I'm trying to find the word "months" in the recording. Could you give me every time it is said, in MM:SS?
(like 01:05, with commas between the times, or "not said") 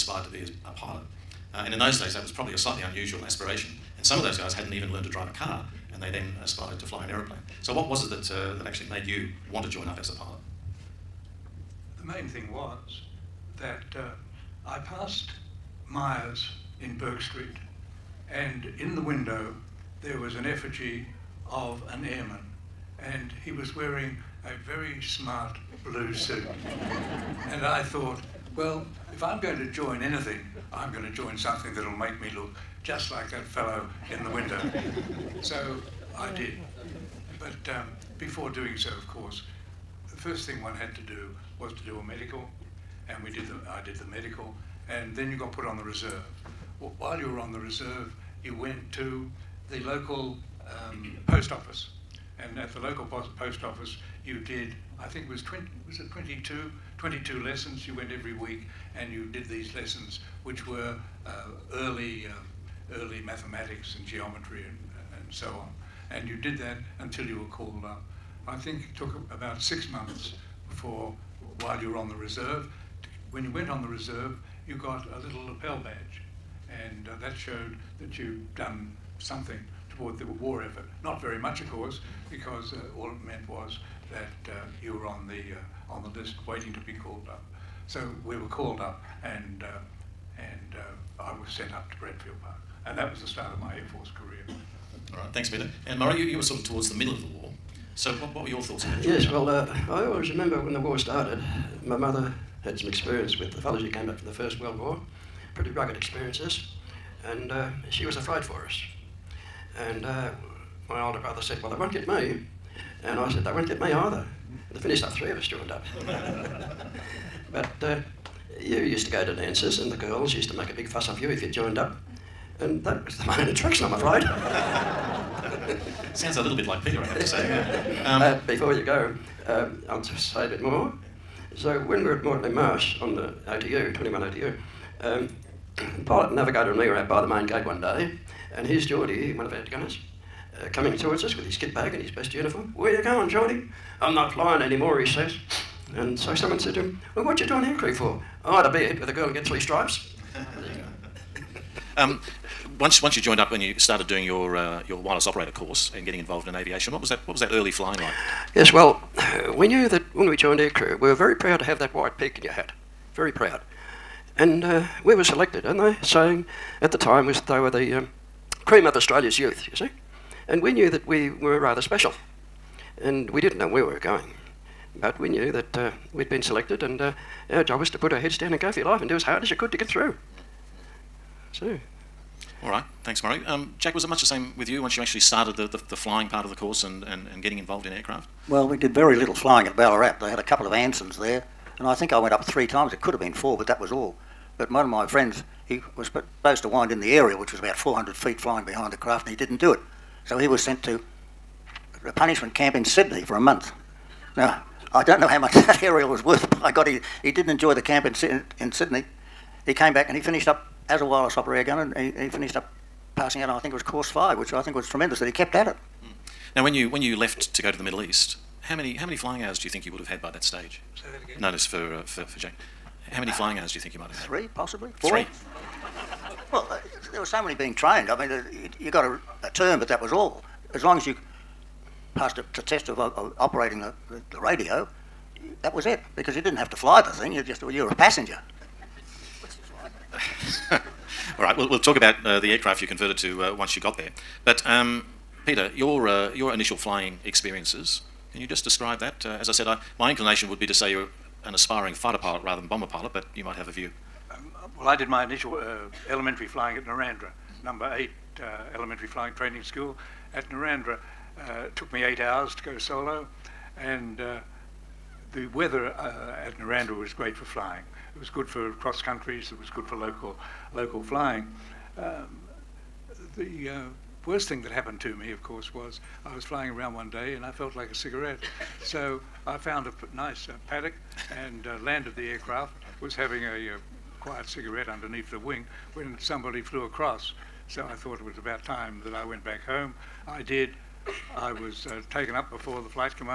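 01:09, 03:23.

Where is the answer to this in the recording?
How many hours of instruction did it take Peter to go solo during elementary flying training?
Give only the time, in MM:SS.
04:22.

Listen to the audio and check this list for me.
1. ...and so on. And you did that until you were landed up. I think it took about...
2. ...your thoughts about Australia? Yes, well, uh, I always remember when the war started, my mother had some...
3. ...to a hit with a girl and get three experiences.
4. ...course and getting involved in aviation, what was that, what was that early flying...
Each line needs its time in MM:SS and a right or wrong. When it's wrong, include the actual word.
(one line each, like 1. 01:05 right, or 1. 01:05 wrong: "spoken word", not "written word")
1. 01:05 wrong: "called", not "landed"
2. 01:38 wrong: "Georgia", not "Australia"
3. 02:28 wrong: "stripes", not "experiences"
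4. 02:35 right.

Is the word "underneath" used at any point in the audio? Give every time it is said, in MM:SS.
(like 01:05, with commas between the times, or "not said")
04:44.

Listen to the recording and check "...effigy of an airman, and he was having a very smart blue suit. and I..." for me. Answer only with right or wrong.
wrong.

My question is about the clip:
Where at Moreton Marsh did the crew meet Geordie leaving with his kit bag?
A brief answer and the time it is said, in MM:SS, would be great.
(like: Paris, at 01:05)
the main gate, at 02:17.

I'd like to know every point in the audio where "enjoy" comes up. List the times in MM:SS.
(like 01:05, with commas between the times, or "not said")
03:27.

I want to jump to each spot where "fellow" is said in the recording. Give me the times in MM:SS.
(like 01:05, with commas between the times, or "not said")
00:33, 01:43.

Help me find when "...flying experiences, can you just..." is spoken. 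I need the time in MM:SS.
04:06.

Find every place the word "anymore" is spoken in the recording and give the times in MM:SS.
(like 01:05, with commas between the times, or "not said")
02:24.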